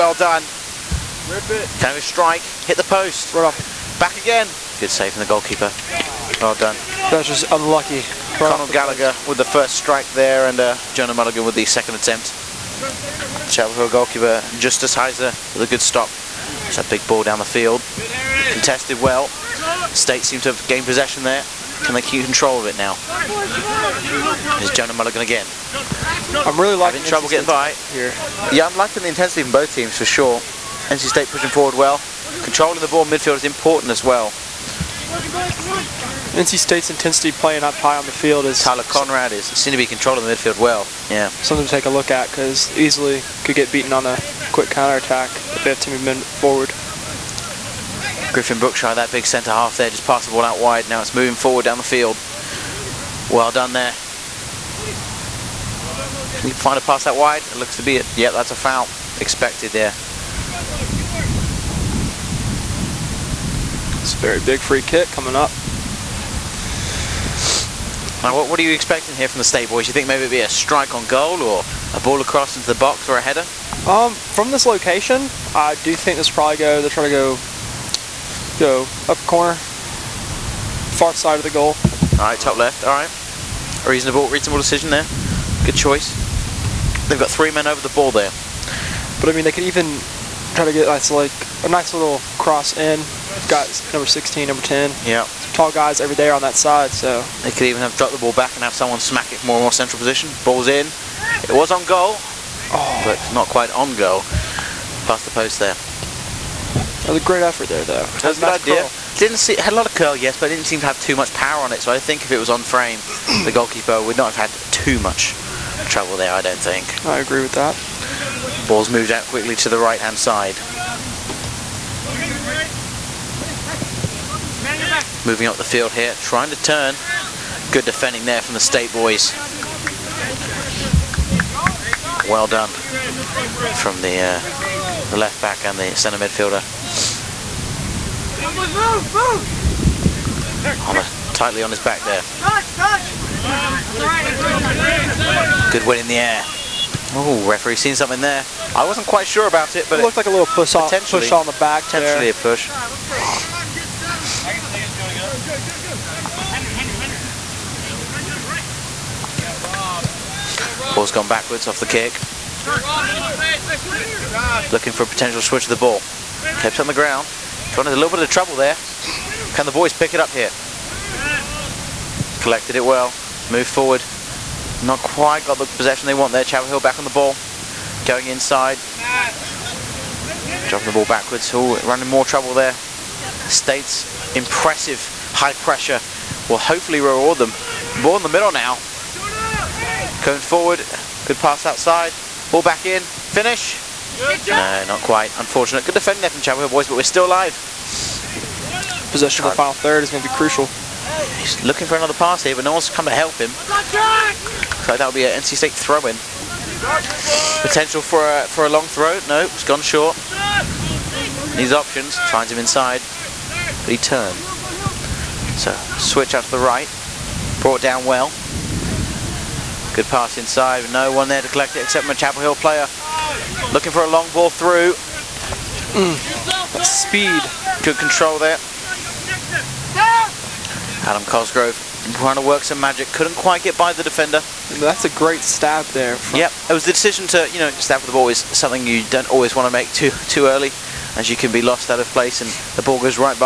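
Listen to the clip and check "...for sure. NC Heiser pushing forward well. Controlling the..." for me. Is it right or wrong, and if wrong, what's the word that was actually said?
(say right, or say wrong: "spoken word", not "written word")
wrong: "State", not "Heiser".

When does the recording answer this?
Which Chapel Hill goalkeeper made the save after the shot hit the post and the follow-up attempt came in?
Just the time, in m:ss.
0:14.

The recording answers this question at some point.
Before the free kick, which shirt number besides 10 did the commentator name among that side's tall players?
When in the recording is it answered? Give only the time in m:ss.
1:34.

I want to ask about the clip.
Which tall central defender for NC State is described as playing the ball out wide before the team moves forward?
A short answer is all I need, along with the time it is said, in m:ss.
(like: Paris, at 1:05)
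Griffin Brookshire, at 0:48.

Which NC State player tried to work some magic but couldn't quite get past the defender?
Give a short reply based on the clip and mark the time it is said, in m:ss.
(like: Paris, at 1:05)
Adam Cosgrove, at 3:49.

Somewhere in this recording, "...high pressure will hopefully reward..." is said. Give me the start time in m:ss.
3:05.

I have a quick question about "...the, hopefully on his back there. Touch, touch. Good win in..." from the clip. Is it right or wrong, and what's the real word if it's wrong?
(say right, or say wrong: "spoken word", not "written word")
wrong: "tightly", not "hopefully".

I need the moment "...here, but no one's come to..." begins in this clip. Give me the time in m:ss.
3:22.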